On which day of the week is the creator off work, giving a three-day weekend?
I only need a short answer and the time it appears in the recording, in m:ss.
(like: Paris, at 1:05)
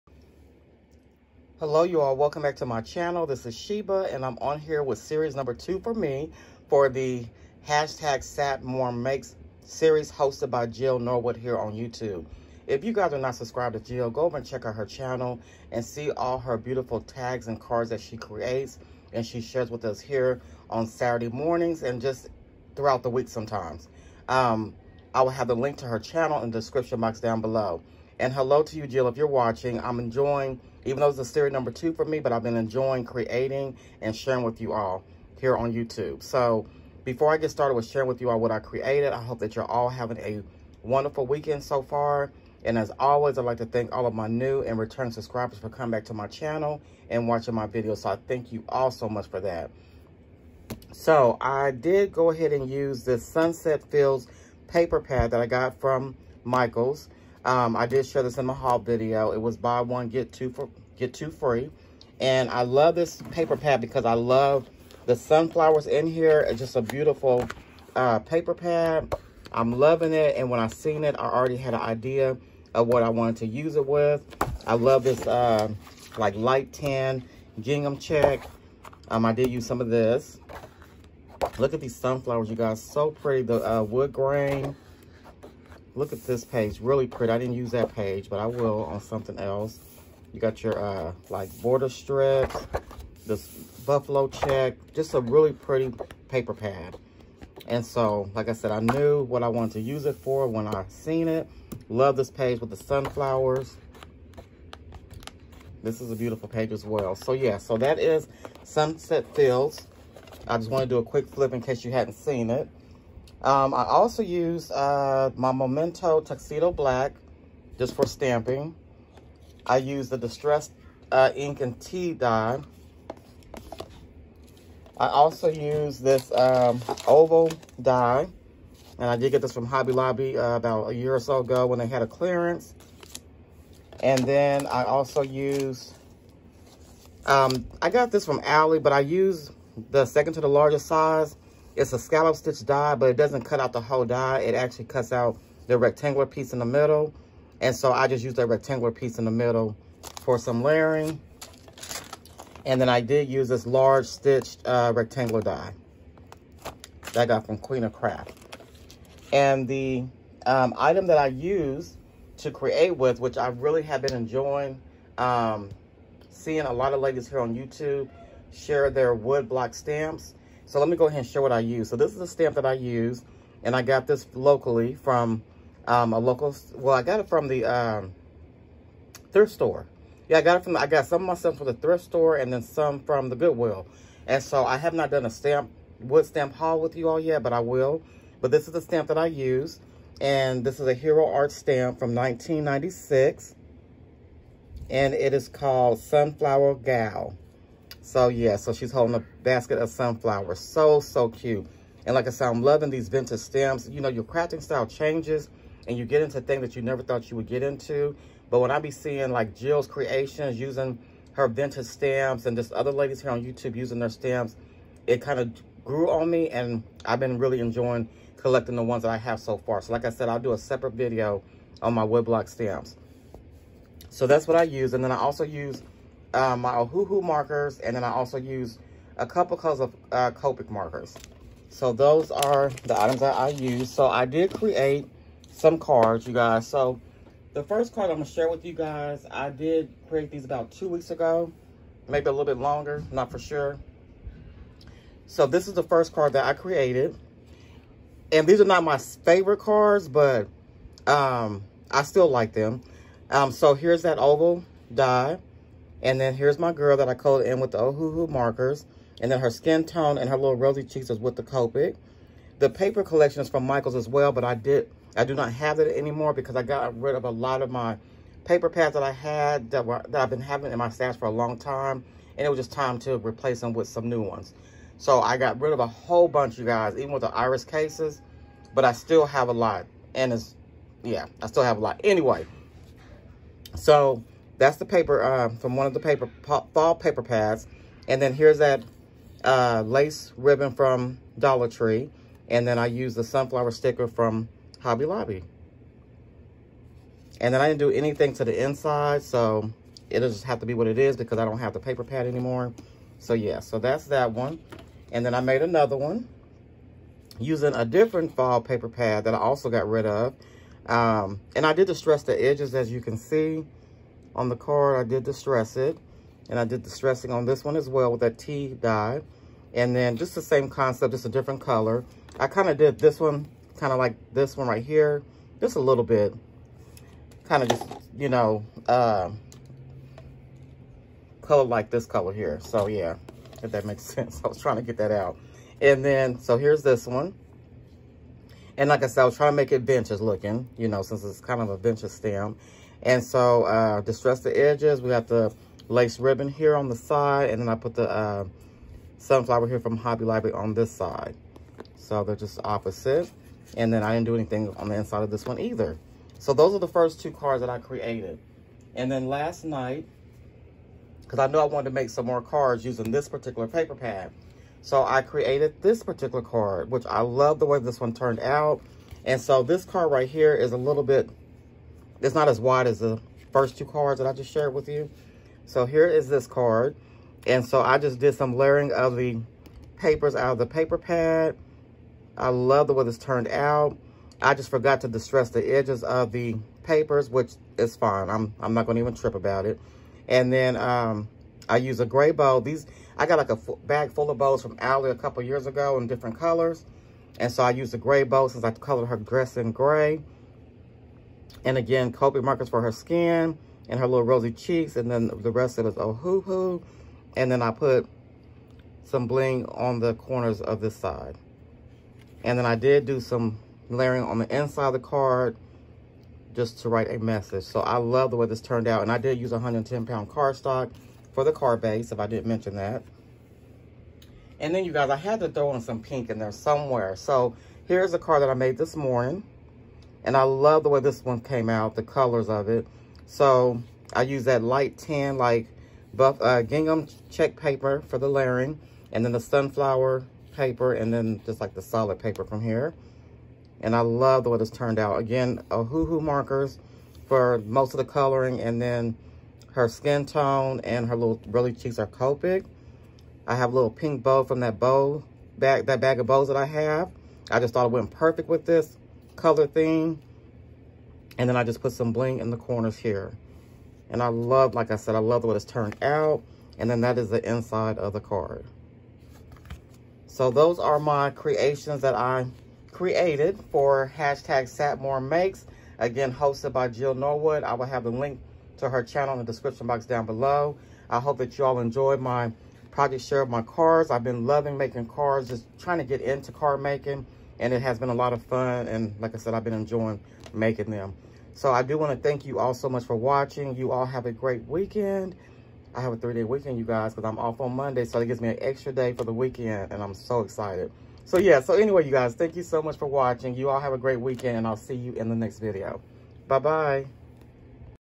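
Monday, at 8:17.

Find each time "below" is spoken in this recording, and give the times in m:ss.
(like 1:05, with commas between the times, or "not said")
0:27, 8:00.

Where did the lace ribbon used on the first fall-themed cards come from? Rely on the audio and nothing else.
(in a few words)
Dollar Tree.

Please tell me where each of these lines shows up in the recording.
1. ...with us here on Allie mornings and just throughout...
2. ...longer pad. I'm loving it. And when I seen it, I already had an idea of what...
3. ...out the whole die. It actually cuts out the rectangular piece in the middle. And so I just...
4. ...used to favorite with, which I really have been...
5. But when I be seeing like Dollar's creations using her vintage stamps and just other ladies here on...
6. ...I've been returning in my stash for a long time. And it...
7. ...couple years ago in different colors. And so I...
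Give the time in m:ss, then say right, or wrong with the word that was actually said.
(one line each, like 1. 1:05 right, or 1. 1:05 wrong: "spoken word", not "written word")
1. 0:19 wrong: "Saturday", not "Allie"
2. 1:08 wrong: "paper", not "longer"
3. 2:23 right
4. 2:41 wrong: "create", not "favorite"
5. 3:28 wrong: "Jill", not "Dollar"
6. 4:30 wrong: "having", not "returning"
7. 6:35 right.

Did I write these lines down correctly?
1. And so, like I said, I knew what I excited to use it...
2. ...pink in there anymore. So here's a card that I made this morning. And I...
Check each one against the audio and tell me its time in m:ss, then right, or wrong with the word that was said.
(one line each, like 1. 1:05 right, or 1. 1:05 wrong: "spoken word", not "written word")
1. 1:37 wrong: "wanted", not "excited"
2. 7:06 wrong: "somewhere", not "anymore".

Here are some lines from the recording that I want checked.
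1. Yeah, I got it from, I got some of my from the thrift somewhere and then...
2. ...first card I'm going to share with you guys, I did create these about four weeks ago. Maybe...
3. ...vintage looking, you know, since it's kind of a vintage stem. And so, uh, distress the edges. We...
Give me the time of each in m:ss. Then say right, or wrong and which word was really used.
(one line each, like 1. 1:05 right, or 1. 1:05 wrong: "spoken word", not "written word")
1. 3:00 wrong: "store", not "somewhere"
2. 3:57 wrong: "two", not "four"
3. 5:39 right.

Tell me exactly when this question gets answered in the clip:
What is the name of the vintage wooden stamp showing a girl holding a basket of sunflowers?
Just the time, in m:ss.
3:15.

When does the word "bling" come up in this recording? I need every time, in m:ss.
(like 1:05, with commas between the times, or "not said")
6:49, 7:42.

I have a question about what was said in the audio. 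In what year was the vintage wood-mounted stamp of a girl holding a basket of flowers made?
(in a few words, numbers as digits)
1996.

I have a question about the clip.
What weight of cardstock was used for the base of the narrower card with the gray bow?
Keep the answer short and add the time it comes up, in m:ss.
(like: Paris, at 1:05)
110 pound, at 6:59.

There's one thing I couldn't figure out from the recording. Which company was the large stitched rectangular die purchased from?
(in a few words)
Queen of Craft.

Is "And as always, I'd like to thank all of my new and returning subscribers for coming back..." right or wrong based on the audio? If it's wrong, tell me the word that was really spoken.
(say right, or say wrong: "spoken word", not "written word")
right.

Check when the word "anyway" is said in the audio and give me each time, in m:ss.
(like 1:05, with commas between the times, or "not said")
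4:42, 8:21.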